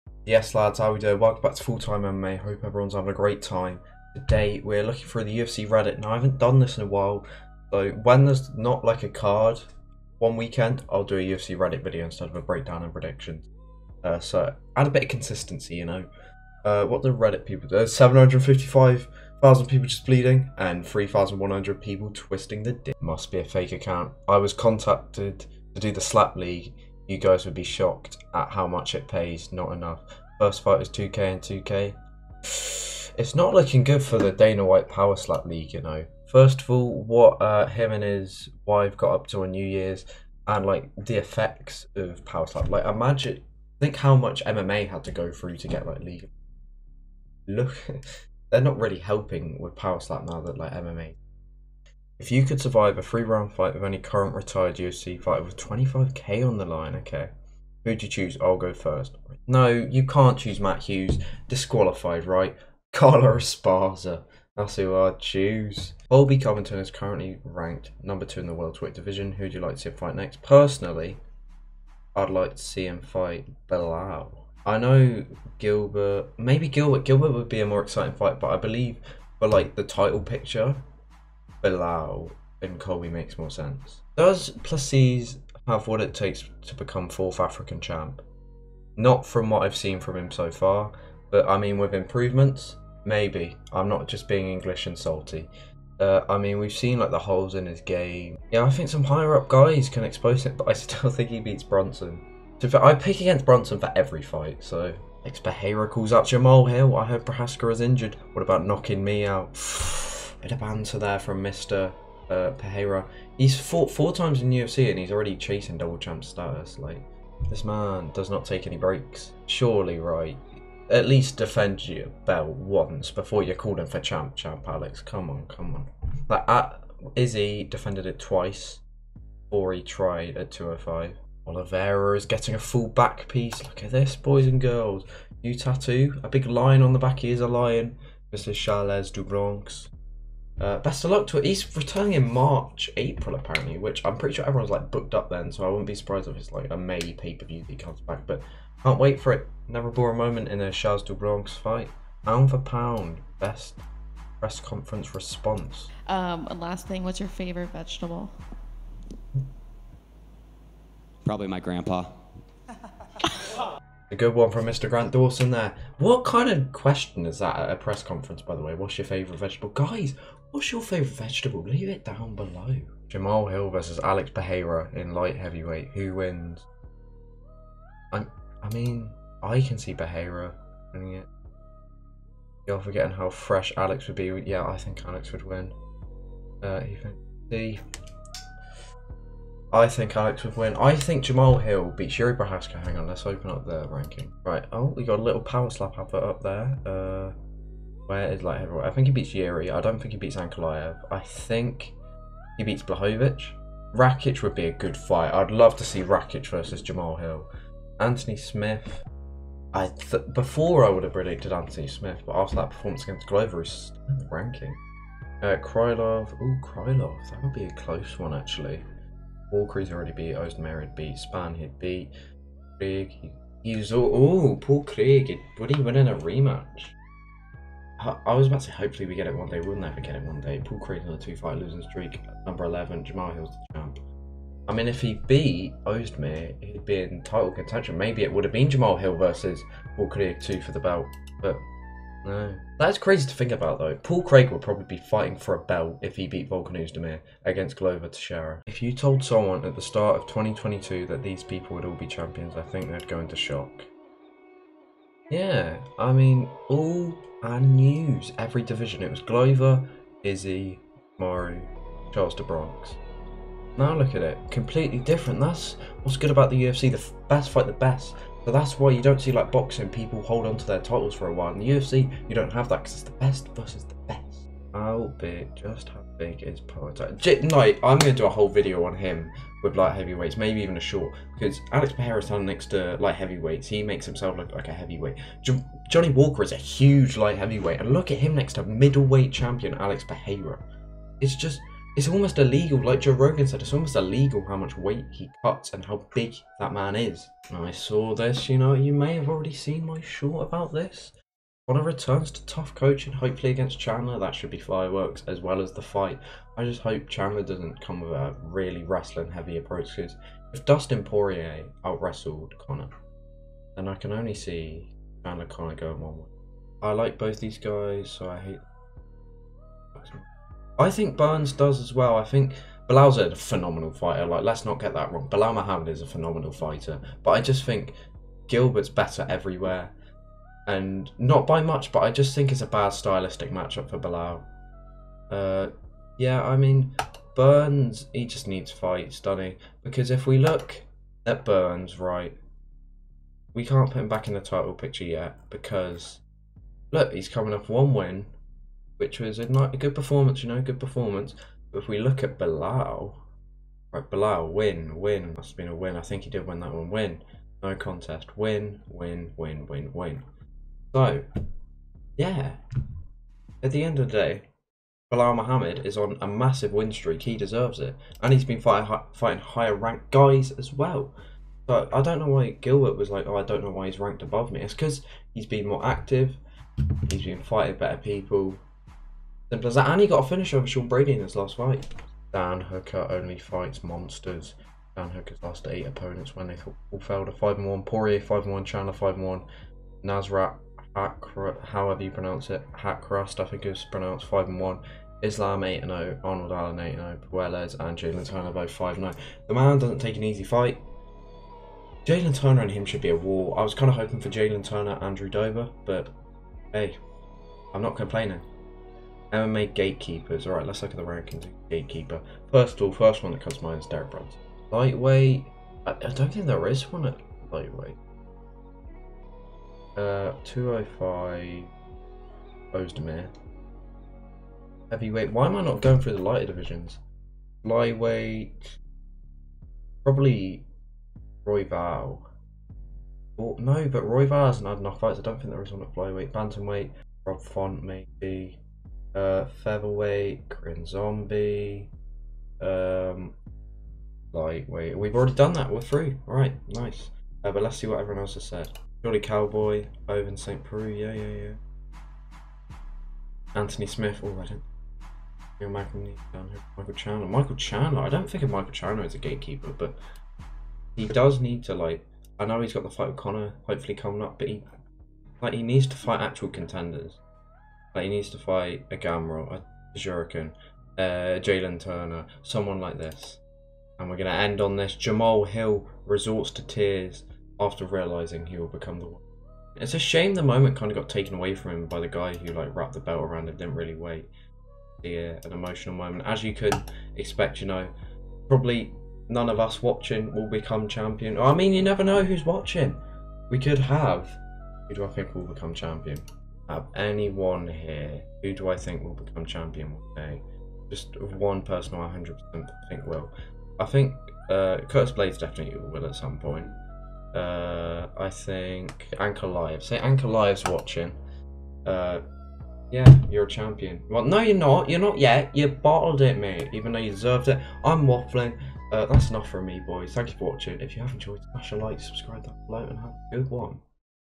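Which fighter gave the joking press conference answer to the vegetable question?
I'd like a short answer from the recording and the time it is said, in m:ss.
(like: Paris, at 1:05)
Grant Dawson, at 2:44.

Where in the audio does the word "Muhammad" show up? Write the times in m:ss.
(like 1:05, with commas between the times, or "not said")
5:25, 6:05.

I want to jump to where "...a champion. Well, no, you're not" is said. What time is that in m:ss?
8:33.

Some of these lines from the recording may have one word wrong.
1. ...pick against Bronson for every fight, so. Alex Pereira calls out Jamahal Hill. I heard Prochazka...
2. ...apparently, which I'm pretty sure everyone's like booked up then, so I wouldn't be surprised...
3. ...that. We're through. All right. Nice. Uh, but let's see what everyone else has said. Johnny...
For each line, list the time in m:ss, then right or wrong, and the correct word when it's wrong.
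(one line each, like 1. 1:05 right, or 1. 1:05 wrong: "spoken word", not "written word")
1. 1:42 right
2. 2:23 right
3. 7:25 right.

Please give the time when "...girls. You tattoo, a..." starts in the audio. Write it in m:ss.
2:14.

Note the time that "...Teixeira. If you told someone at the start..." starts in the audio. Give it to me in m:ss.
4:08.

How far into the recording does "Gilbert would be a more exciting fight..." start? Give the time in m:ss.
1:17.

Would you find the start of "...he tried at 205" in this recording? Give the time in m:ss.
2:09.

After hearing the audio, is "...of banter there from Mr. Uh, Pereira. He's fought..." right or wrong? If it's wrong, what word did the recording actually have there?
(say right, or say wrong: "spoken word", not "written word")
right.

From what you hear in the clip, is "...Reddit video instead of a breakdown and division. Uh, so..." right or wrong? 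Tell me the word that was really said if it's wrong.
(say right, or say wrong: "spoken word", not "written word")
wrong: "prediction", not "division".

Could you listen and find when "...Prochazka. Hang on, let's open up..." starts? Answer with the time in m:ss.
3:12.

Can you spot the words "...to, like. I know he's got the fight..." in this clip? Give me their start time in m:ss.
7:41.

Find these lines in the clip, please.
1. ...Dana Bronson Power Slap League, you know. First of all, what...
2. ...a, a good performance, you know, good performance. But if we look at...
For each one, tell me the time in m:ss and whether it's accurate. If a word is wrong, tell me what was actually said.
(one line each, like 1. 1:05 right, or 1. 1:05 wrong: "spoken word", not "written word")
1. 0:34 wrong: "White", not "Bronson"
2. 5:49 right.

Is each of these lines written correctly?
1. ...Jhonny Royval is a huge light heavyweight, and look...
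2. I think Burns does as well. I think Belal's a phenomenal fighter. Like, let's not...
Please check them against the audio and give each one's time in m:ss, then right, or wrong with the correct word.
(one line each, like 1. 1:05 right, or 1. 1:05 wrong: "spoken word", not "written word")
1. 4:45 wrong: "Walker", not "Royval"
2. 5:20 right.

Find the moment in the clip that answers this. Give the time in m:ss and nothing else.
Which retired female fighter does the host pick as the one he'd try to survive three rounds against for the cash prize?
1:02.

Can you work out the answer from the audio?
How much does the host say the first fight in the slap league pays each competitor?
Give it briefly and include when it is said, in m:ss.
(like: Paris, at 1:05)
2k and 2k, at 0:30.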